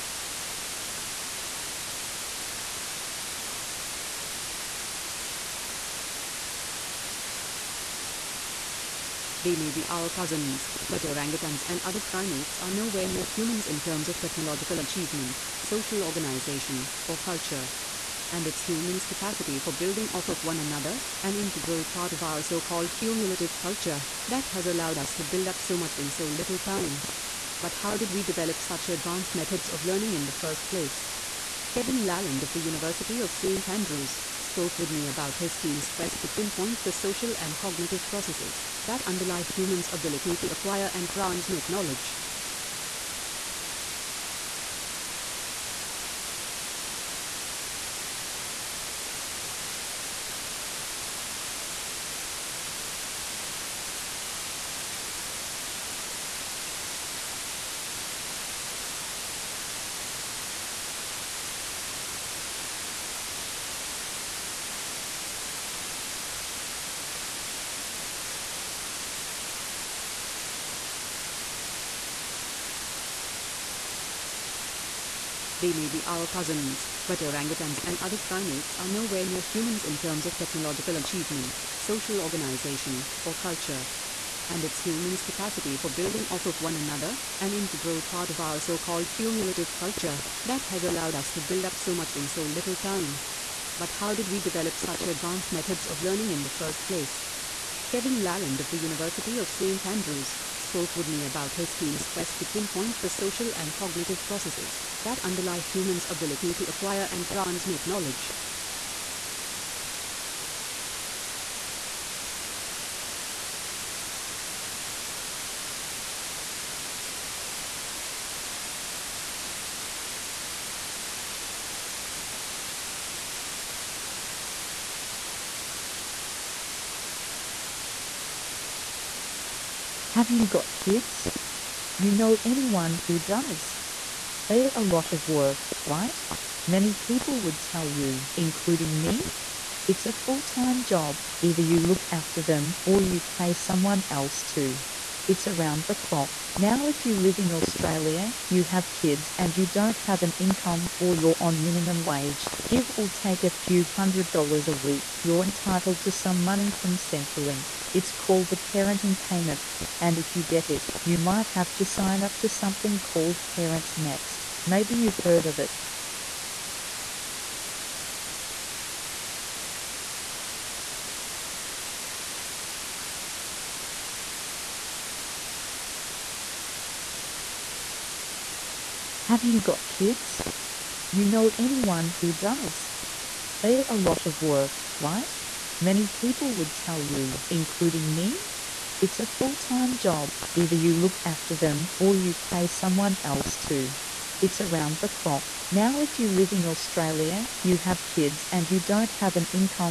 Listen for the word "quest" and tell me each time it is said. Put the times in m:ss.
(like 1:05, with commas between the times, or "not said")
0:35, 1:42.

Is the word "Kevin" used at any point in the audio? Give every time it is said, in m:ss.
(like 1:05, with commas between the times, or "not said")
0:31, 1:37.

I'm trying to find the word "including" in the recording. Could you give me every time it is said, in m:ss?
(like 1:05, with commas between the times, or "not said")
2:18, 3:07.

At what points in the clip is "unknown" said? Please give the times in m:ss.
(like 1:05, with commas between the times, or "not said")
not said.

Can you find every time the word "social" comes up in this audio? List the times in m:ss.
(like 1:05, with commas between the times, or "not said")
0:15, 0:36, 1:21, 1:43.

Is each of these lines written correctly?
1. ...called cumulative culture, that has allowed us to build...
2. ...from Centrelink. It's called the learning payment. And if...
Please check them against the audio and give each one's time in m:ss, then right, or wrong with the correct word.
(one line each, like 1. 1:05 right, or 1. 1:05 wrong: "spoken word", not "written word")
1. 1:28 right
2. 2:36 wrong: "parenting", not "learning".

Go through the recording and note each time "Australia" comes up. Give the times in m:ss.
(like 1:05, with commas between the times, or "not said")
2:27, 3:16.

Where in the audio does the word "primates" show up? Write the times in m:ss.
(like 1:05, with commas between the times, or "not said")
0:12, 1:18.